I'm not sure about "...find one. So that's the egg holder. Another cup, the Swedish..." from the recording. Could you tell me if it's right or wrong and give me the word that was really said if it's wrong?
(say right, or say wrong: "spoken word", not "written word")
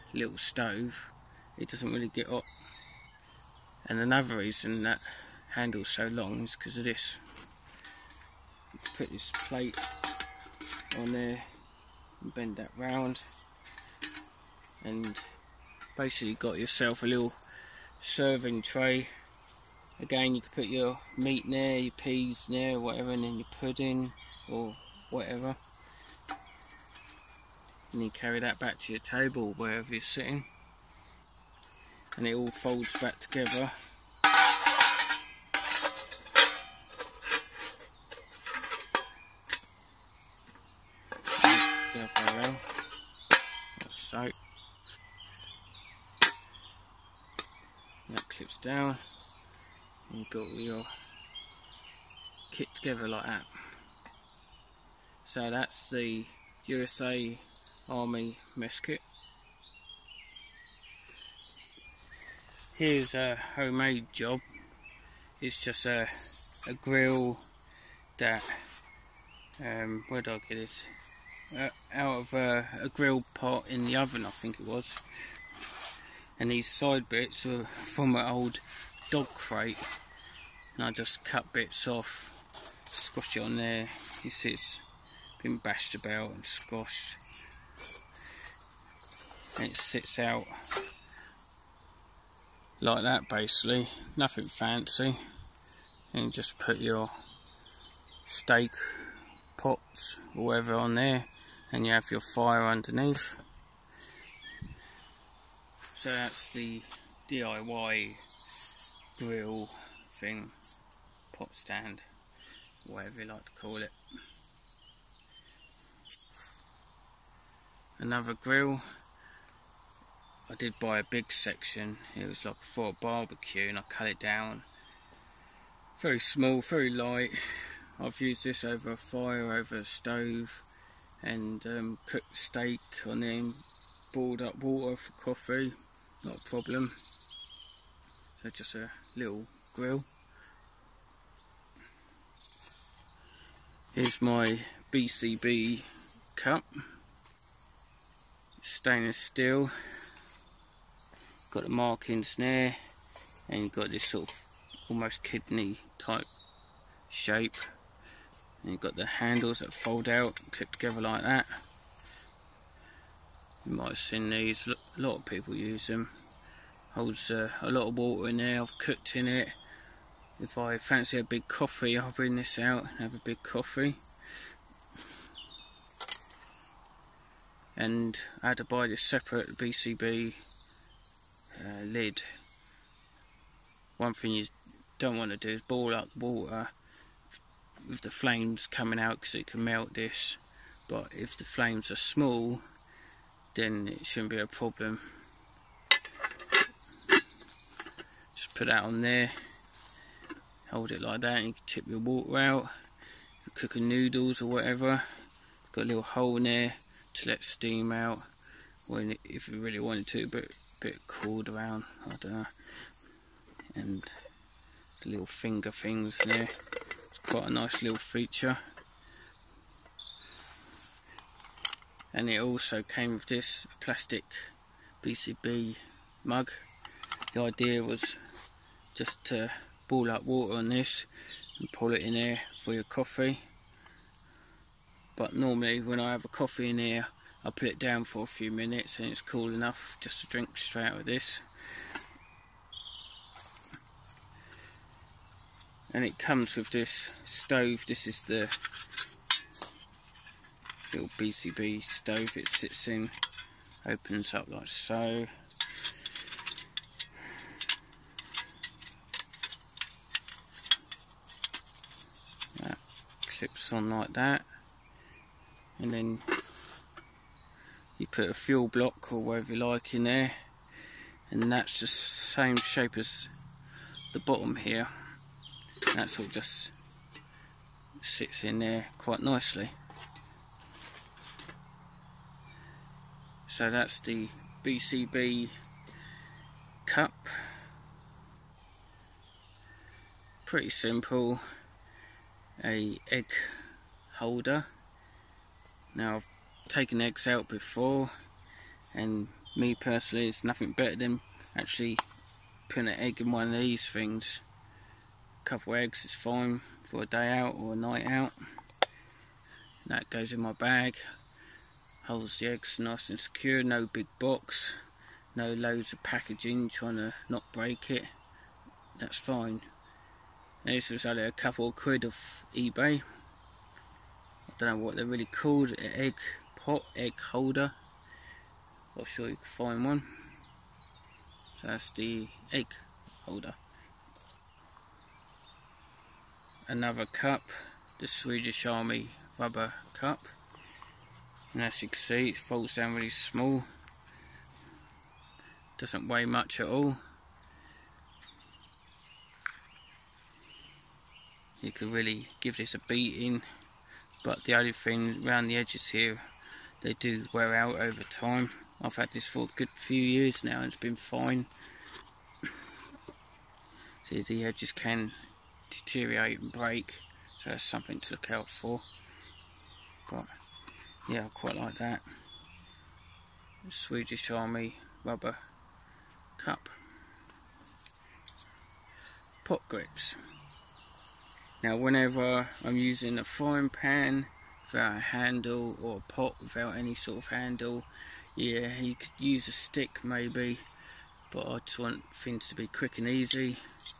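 right.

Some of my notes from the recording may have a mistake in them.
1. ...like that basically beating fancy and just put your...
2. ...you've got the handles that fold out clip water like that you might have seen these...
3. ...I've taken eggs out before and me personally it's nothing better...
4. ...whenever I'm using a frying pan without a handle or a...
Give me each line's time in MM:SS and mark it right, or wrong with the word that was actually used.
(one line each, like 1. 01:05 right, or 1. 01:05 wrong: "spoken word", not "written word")
1. 01:32 wrong: "nothing", not "beating"
2. 02:38 wrong: "together", not "water"
3. 04:56 right
4. 06:21 right.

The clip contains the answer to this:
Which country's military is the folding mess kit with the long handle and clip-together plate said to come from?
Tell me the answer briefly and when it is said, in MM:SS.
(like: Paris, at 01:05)
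USA, at 00:56.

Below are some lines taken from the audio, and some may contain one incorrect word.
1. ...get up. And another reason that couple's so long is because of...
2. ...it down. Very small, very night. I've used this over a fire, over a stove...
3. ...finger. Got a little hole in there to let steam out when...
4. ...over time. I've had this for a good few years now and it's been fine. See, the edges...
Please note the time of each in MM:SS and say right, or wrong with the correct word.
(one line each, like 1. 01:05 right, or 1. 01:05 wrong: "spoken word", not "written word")
1. 00:02 wrong: "handle", not "couple"
2. 02:04 wrong: "light", not "night"
3. 03:24 wrong: "whatever", not "finger"
4. 05:57 right.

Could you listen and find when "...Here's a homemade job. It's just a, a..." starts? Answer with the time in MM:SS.
01:02.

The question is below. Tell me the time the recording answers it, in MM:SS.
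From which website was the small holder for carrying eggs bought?
05:22.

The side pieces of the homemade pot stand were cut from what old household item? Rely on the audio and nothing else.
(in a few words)
dog crate.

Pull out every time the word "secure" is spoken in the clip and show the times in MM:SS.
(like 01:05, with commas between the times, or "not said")
05:13.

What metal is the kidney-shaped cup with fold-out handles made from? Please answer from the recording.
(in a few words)
Stainless steel.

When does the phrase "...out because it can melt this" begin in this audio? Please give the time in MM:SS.
03:08.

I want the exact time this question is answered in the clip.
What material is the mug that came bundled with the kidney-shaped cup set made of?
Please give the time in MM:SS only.
03:43.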